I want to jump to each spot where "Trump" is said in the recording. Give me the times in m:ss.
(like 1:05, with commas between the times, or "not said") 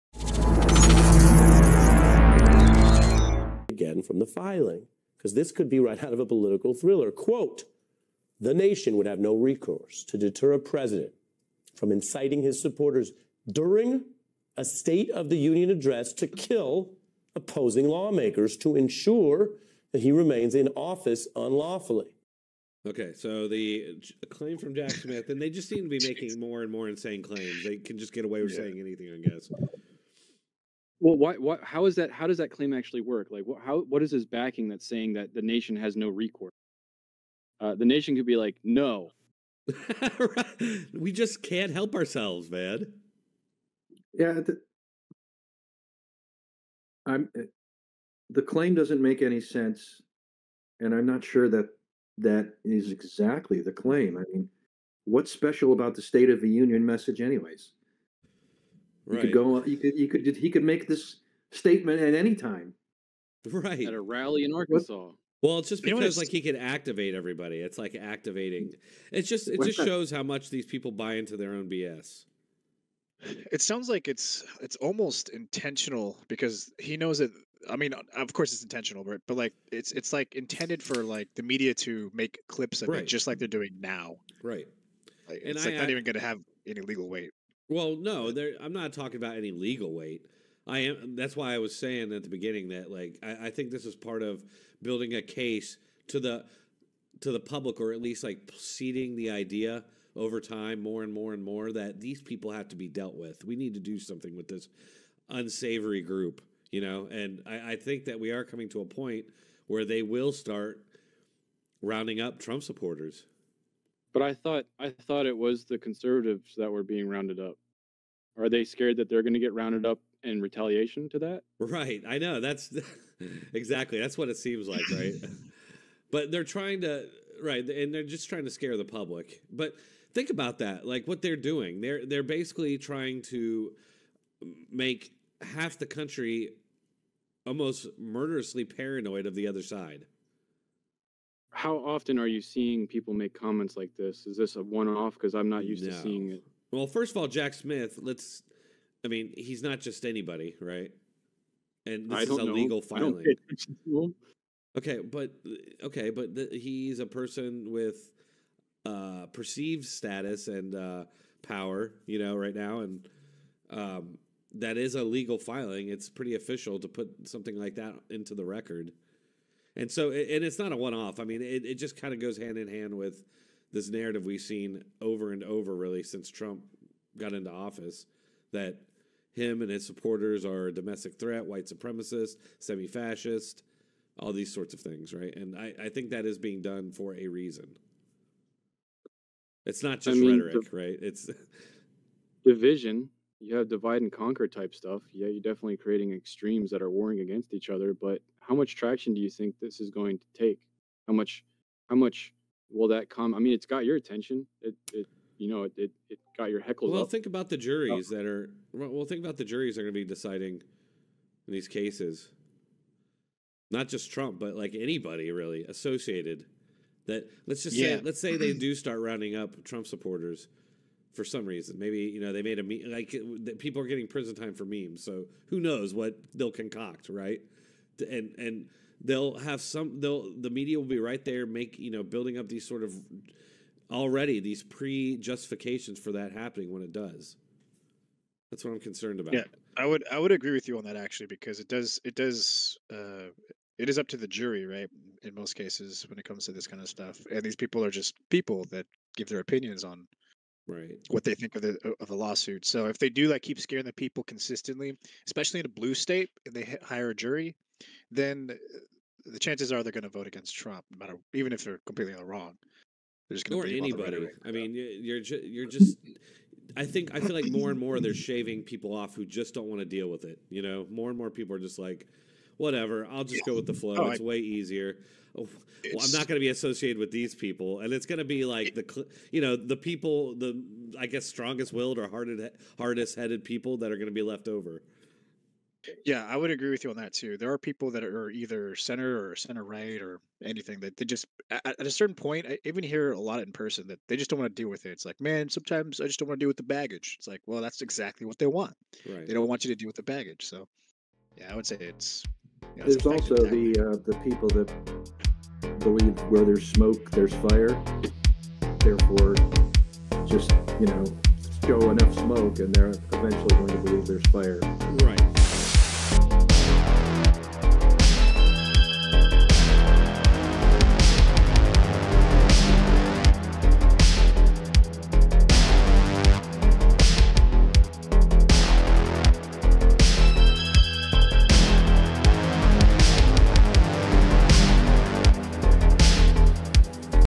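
1:52, 2:56, 3:34, 3:39, 4:20.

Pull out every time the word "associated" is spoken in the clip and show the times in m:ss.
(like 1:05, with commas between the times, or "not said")
3:35, 4:36.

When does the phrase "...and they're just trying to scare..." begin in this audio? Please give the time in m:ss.
2:07.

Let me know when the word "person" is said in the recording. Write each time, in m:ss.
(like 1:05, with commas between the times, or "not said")
2:37, 4:53.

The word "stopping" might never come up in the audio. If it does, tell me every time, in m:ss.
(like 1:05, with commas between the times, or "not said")
not said.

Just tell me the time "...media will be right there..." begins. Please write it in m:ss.
3:50.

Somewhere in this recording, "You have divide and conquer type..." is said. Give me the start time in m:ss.
3:13.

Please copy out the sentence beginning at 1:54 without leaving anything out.
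But I thought I thought it was the conservatives that were being rounded up.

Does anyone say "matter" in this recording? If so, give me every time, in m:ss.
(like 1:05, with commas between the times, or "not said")
4:20.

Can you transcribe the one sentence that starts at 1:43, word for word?
We need to do something with this unsavory group, you know.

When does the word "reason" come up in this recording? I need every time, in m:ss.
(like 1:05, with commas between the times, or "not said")
3:07, 3:41.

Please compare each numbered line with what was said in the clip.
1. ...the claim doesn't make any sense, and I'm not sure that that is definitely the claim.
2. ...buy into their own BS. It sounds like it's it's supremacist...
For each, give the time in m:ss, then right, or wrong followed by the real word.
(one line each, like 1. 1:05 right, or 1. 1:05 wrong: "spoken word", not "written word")
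1. 0:48 wrong: "exactly", not "definitely"
2. 1:10 wrong: "almost", not "supremacist".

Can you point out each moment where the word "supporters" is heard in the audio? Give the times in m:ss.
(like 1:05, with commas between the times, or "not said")
0:12, 1:52, 2:59, 3:39.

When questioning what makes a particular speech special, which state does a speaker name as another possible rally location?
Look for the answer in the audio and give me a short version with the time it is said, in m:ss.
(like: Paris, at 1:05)
Arkansas, at 1:04.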